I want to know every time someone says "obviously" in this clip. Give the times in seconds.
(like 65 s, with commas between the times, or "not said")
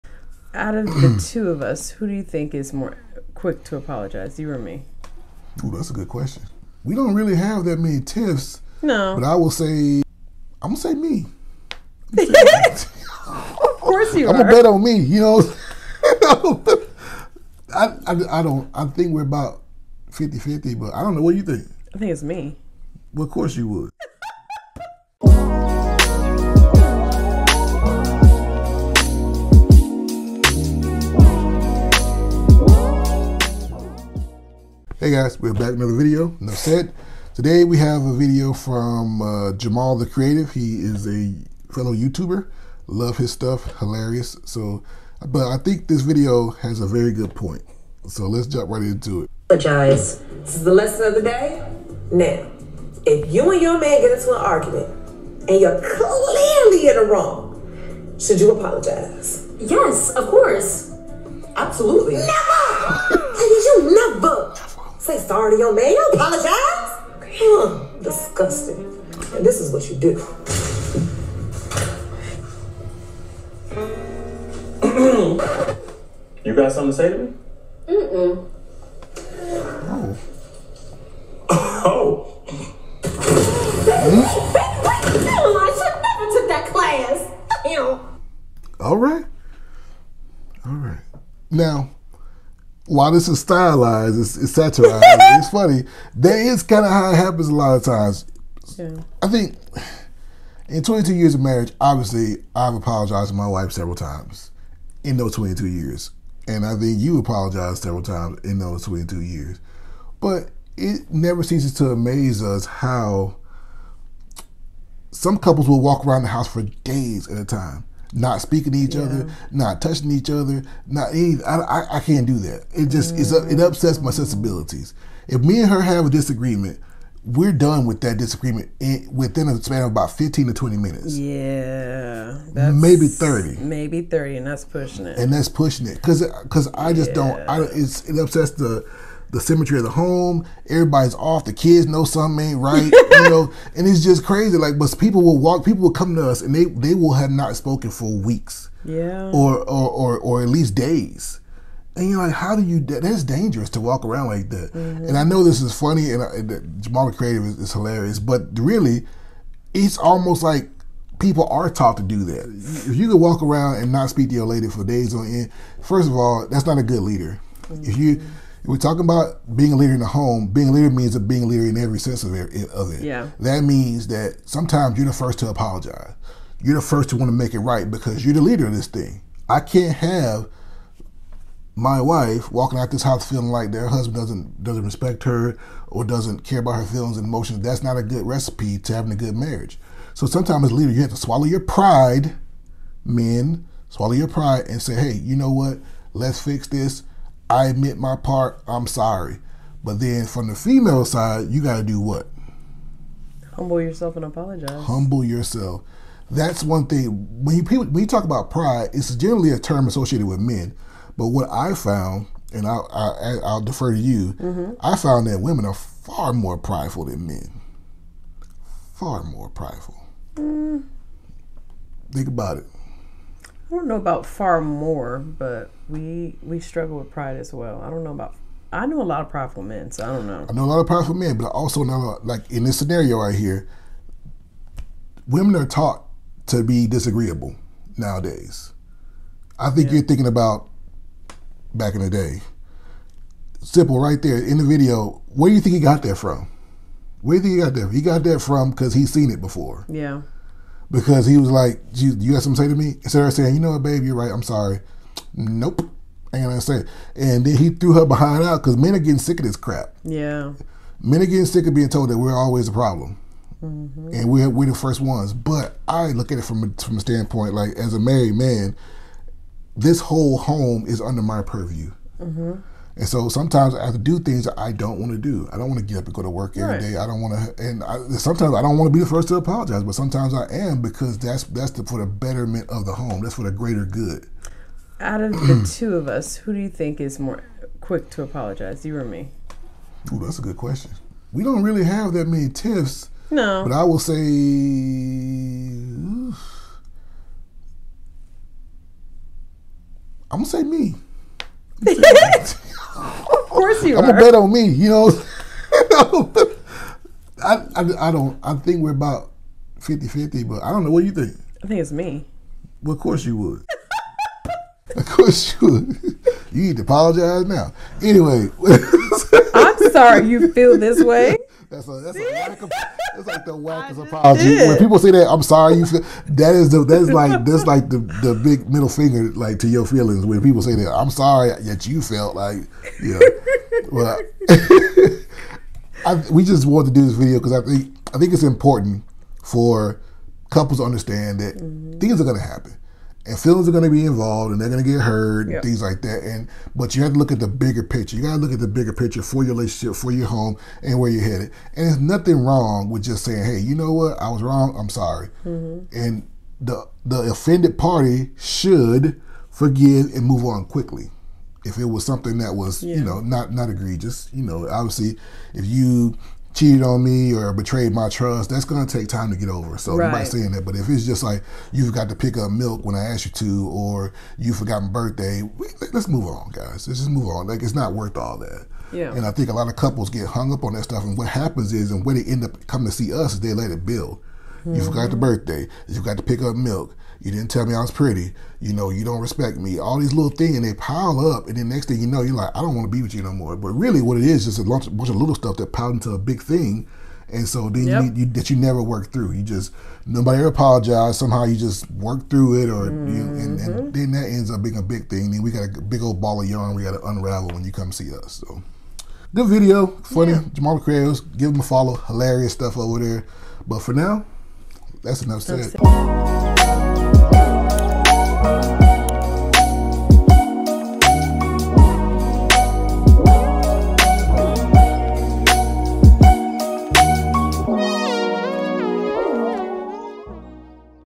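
101 s, 364 s.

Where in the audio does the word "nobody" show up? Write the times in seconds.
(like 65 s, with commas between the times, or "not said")
370 s, 400 s.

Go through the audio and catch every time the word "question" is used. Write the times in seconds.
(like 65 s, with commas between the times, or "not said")
6 s, 290 s.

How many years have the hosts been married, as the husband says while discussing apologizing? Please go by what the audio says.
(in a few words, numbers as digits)
22.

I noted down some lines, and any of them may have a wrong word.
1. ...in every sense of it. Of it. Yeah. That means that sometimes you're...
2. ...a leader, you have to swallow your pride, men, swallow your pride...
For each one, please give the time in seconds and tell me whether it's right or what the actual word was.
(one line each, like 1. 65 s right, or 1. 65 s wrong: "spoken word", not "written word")
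1. 171 s right
2. 190 s right.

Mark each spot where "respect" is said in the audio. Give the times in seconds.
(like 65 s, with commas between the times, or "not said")
184 s, 389 s.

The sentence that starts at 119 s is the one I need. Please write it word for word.
other, not touching each other, not any.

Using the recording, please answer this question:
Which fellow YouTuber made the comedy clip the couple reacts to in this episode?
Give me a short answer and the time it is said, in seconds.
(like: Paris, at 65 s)
Jamal the Creative, at 39 s.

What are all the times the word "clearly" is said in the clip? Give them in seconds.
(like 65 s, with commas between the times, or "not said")
55 s.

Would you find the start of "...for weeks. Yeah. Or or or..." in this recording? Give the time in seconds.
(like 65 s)
147 s.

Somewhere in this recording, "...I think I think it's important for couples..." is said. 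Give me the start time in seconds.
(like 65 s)
337 s.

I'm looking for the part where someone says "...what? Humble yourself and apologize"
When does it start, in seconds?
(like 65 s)
201 s.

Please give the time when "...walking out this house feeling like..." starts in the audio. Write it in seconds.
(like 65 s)
182 s.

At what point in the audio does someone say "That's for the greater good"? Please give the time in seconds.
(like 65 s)
283 s.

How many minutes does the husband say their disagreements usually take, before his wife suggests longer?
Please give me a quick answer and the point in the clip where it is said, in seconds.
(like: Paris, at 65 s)
15 to 20 minutes, at 130 s.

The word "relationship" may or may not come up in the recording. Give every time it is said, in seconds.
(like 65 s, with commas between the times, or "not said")
349 s.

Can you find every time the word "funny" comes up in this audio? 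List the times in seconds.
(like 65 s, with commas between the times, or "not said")
95 s, 155 s, 410 s.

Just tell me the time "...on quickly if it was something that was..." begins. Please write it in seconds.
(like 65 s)
360 s.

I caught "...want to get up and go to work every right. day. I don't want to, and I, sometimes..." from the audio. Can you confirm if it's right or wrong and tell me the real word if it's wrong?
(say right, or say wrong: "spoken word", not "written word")
right.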